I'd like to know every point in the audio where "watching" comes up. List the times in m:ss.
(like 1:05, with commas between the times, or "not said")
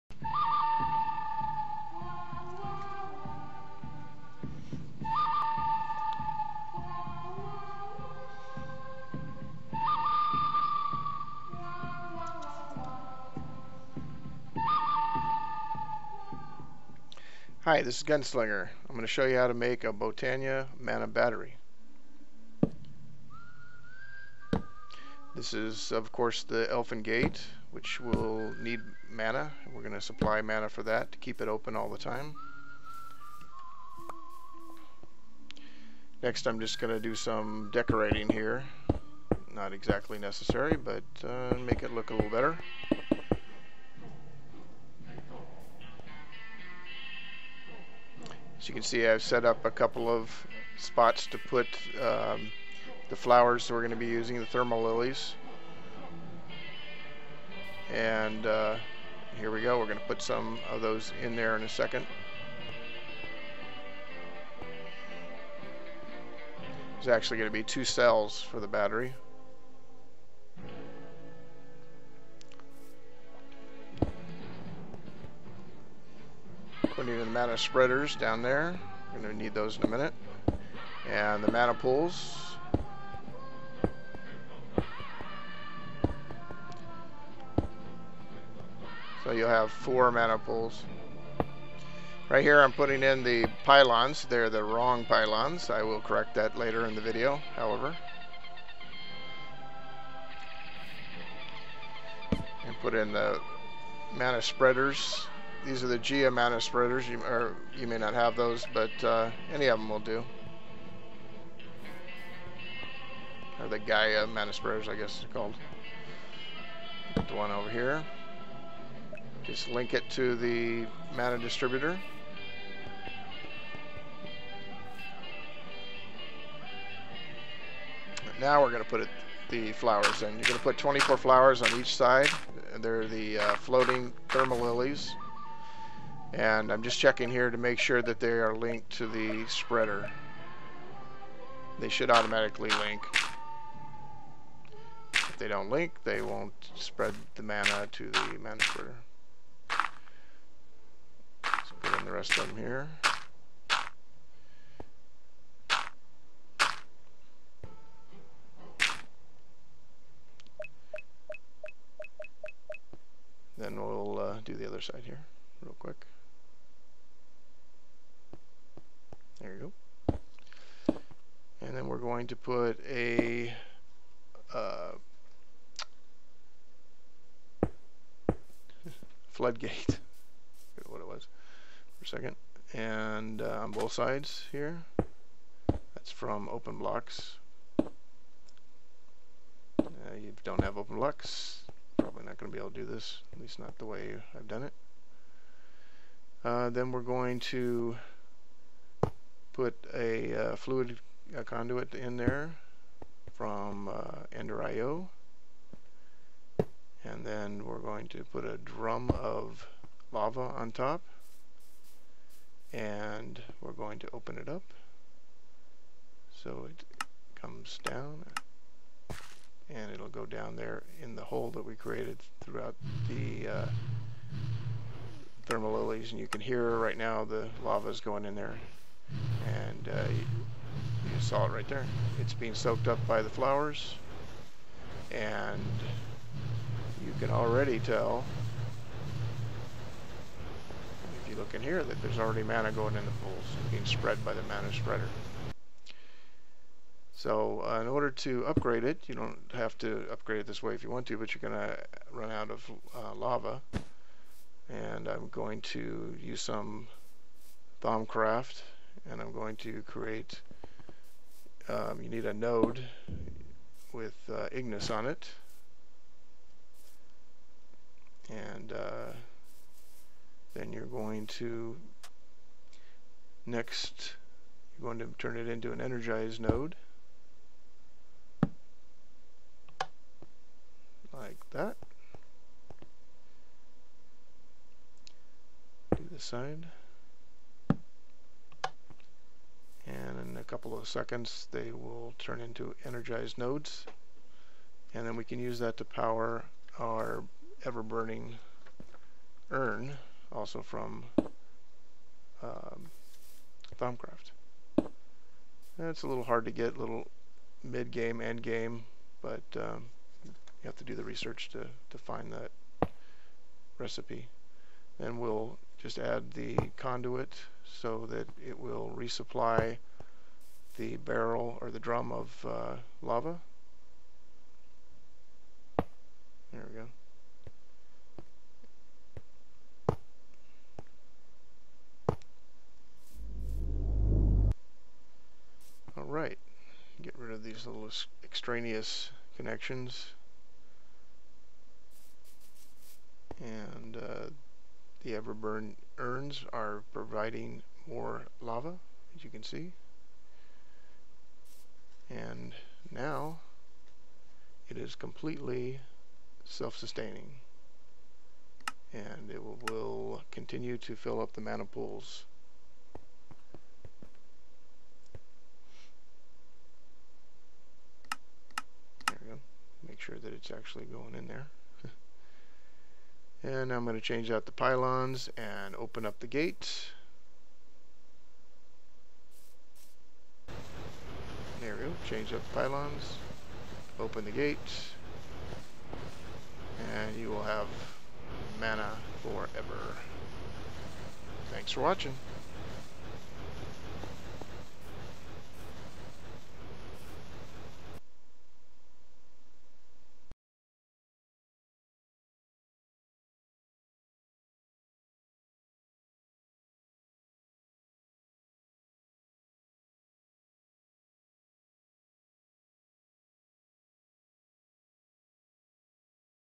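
6:31.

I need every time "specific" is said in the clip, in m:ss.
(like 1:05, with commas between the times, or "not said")
not said.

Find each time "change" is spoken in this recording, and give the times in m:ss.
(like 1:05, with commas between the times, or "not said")
6:14, 6:22.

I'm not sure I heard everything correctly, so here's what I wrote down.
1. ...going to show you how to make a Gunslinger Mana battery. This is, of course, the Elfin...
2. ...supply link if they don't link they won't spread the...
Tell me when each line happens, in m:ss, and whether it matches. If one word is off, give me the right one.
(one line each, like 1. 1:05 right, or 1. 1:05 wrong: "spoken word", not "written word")
1. 0:18 wrong: "Botania", not "Gunslinger"
2. 2:22 wrong: "automatically", not "supply".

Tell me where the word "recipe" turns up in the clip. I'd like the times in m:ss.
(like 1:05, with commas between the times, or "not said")
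5:13.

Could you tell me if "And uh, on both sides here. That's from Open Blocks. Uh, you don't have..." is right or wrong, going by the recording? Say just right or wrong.
right.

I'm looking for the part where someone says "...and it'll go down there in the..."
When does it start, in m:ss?
3:39.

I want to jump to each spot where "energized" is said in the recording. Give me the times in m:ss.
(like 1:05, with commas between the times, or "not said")
4:35, 4:52.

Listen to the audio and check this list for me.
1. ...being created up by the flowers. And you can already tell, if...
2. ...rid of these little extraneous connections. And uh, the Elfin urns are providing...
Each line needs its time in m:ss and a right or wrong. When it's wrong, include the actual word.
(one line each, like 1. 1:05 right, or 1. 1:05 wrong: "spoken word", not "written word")
1. 3:52 wrong: "soaked", not "created"
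2. 5:37 wrong: "Everburn", not "Elfin".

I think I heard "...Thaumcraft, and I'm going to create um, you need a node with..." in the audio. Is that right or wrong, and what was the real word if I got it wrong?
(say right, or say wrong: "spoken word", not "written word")
right.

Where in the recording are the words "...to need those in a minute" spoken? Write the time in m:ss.
1:19.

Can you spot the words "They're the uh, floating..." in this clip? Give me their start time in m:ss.
2:12.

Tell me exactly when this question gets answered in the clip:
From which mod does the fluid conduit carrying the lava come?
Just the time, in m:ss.
3:24.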